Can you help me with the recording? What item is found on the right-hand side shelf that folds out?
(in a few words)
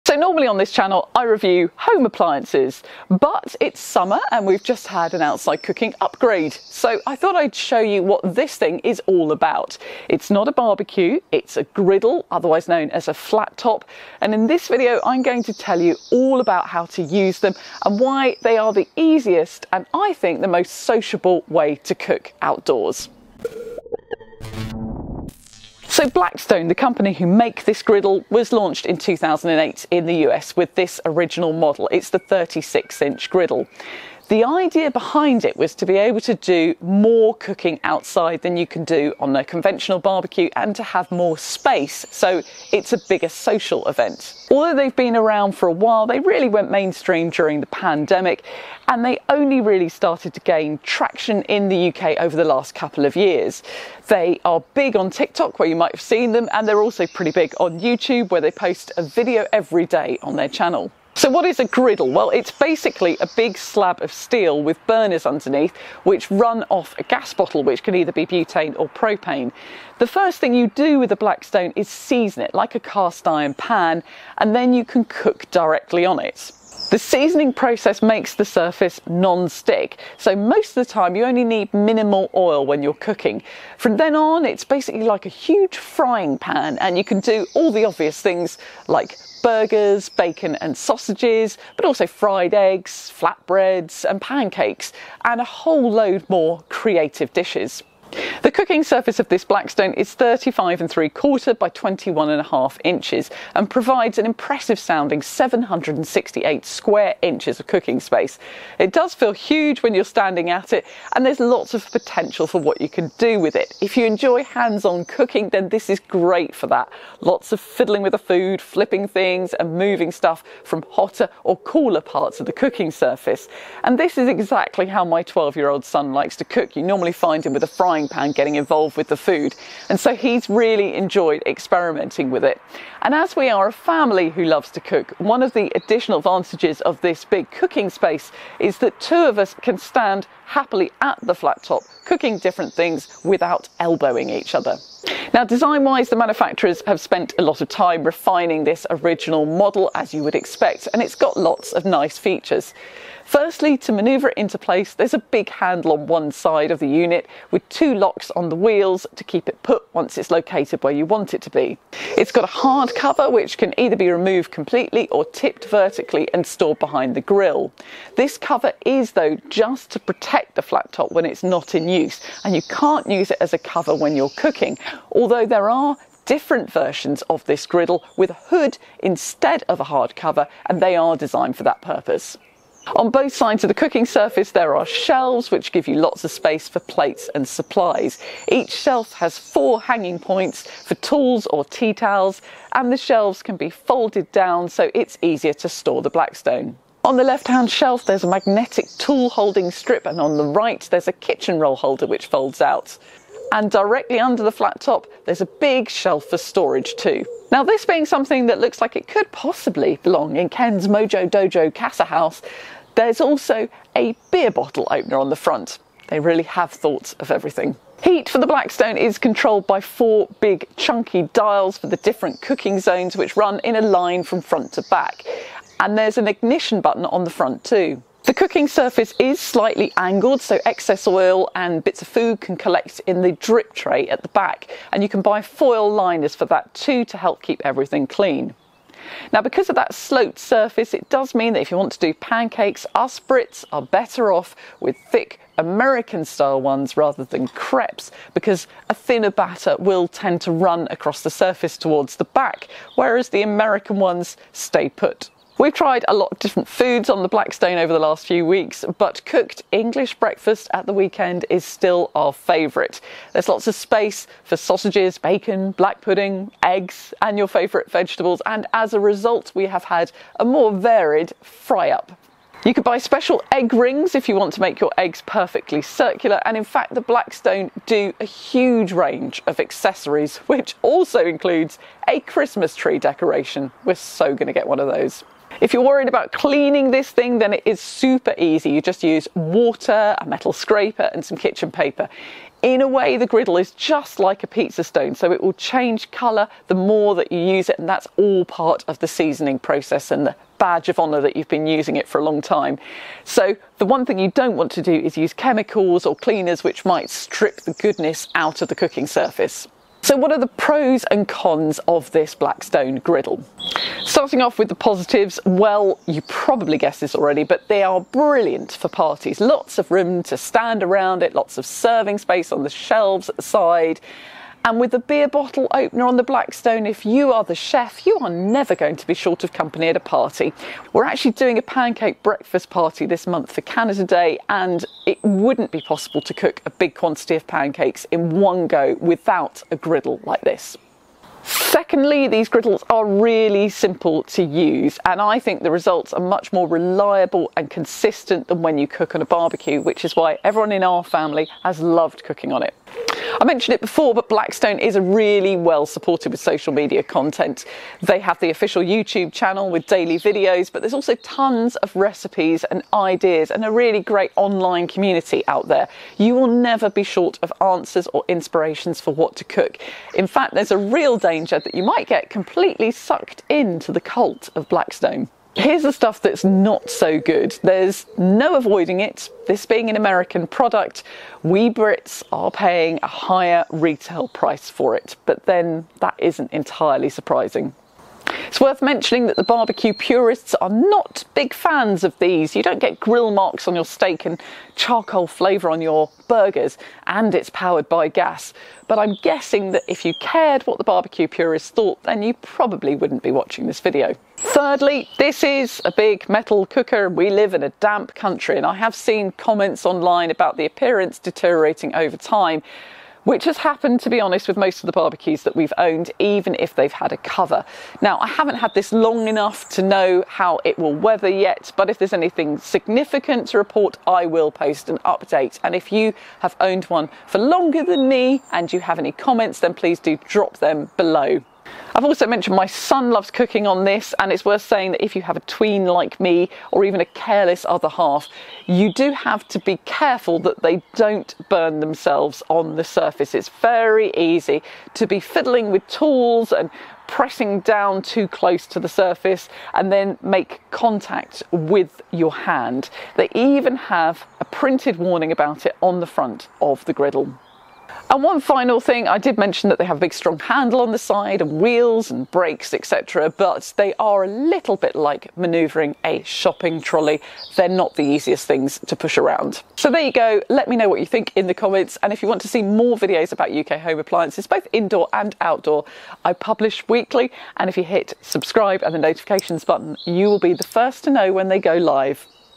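Kitchen roll holder.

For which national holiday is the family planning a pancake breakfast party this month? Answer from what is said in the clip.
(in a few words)
Canada Day.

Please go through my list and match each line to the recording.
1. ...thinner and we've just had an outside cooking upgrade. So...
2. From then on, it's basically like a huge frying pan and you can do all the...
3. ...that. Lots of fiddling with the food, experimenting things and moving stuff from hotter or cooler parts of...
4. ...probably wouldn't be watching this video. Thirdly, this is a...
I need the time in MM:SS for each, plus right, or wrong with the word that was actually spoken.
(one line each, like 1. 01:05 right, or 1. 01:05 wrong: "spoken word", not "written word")
1. 00:03 wrong: "summer", not "thinner"
2. 01:23 right
3. 01:56 wrong: "flipping", not "experimenting"
4. 06:42 right.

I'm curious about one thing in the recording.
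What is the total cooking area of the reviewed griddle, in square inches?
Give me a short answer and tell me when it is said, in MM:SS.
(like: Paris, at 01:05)
768, at 01:45.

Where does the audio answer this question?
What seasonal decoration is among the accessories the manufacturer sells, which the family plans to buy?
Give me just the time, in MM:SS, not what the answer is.
04:42.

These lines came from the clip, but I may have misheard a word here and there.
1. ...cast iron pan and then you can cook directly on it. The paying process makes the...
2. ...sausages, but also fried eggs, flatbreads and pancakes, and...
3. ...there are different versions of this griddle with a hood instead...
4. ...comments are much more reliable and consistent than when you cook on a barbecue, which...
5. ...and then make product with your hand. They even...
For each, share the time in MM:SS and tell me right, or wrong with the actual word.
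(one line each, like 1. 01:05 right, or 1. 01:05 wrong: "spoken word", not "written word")
1. 01:12 wrong: "seasoning", not "paying"
2. 01:30 right
3. 02:55 right
4. 05:45 wrong: "results", not "comments"
5. 07:29 wrong: "contact", not "product".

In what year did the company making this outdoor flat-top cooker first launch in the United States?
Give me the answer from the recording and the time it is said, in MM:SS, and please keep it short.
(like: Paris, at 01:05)
2008, at 00:28.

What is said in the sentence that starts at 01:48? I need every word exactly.
It does feel huge when you're standing at it and there's lots of potential for what you can do with it.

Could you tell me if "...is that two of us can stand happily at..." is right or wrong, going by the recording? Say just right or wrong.
right.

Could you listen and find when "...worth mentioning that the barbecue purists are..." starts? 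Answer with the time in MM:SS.
06:28.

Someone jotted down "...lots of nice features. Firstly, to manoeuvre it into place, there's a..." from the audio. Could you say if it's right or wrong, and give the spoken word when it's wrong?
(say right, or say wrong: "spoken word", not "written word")
right.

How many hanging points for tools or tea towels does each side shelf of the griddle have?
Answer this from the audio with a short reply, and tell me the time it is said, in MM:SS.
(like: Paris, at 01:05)
4, at 03:09.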